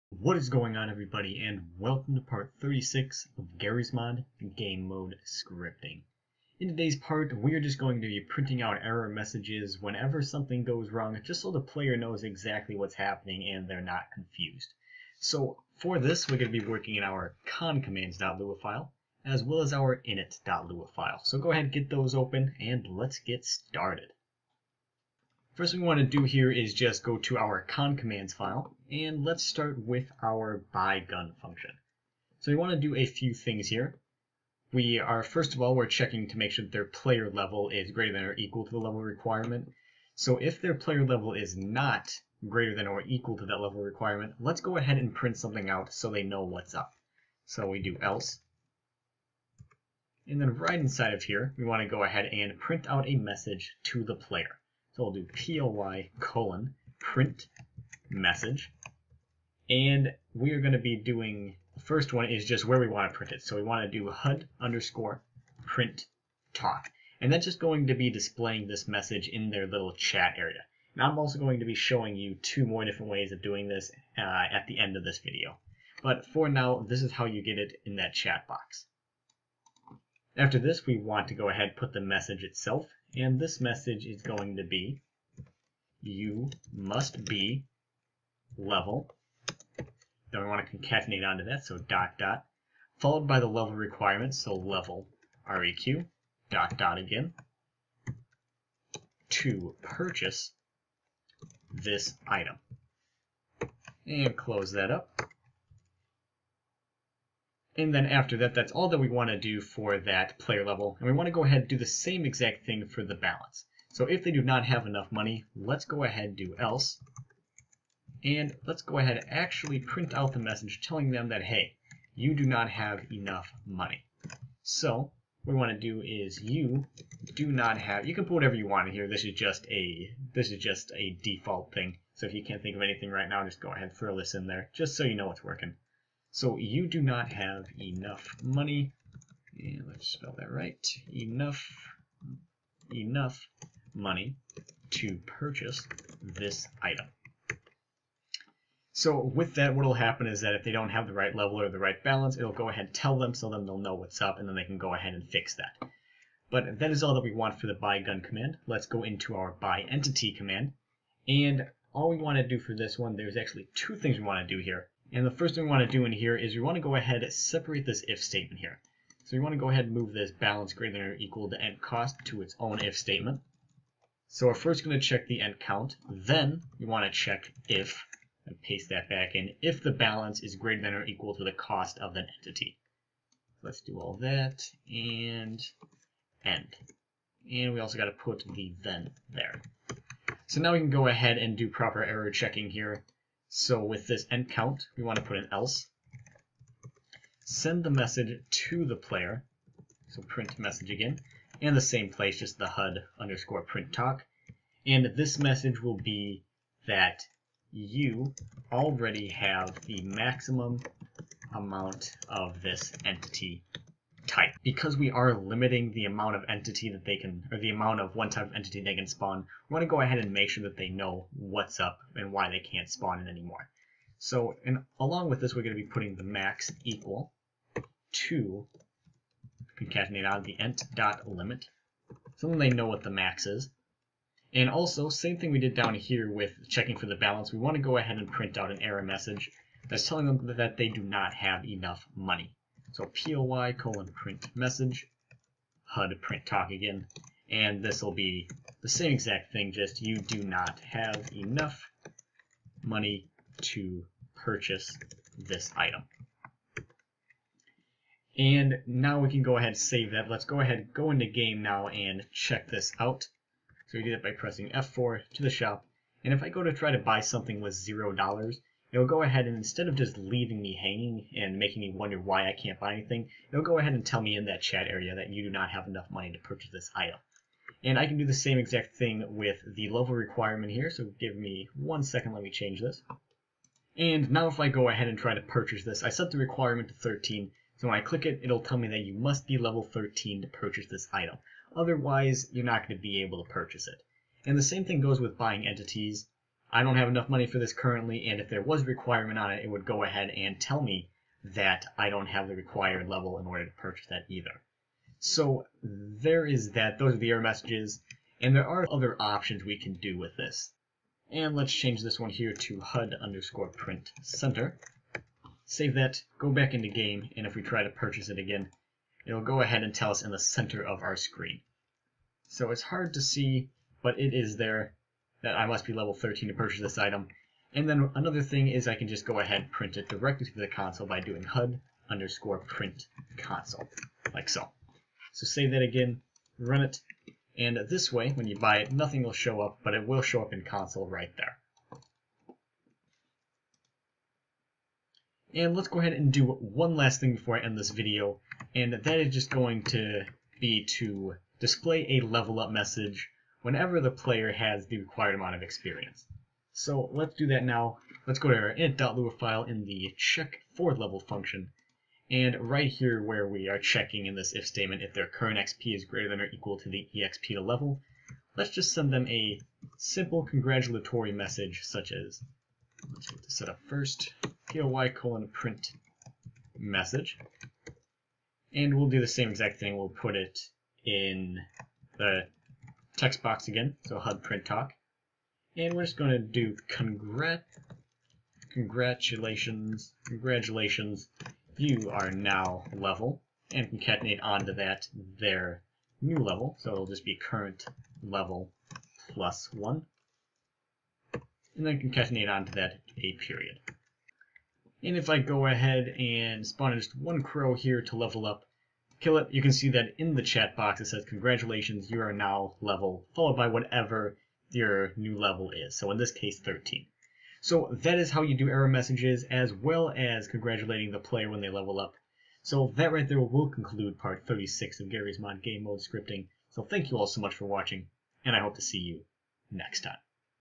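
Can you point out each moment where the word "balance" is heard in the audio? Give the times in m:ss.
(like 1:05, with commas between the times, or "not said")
1:53, 2:32, 2:50, 2:59, 3:57.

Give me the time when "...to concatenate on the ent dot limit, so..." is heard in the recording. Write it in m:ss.
3:48.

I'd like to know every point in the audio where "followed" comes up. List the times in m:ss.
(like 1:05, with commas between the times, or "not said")
1:32, 6:53.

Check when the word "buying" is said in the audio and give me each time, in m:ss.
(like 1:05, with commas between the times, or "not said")
4:55.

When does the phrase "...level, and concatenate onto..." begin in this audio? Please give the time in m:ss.
6:32.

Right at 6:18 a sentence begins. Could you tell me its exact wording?
And we'll do the same exact thing.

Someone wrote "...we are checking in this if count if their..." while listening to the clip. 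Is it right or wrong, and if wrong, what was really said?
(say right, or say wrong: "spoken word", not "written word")
wrong: "statement", not "count".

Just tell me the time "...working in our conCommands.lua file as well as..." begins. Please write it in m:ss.
0:16.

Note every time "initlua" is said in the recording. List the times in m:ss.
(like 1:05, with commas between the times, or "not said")
0:20, 5:58.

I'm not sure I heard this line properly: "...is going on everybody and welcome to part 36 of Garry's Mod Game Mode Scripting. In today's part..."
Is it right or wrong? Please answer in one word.
right.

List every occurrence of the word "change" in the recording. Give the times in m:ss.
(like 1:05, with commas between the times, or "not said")
4:42, 5:11.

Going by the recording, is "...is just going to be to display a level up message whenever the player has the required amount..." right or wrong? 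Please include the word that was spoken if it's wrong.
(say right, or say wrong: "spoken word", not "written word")
right.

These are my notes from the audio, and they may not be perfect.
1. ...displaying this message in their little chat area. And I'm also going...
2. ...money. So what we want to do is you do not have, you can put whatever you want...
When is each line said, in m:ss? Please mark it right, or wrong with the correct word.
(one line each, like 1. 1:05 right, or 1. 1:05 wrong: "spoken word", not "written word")
1. 1:08 right
2. 2:03 right.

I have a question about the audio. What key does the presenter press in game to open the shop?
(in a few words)
F4.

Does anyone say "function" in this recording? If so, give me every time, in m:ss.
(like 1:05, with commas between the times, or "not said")
0:31, 6:01.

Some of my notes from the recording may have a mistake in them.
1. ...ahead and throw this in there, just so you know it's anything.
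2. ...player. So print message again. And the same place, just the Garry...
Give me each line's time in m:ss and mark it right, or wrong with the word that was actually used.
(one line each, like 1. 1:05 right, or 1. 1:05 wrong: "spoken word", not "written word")
1. 2:13 wrong: "working", not "anything"
2. 3:18 wrong: "HUD", not "Garry".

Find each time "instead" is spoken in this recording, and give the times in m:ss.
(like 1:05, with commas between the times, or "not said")
4:29.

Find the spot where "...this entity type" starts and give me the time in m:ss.
3:32.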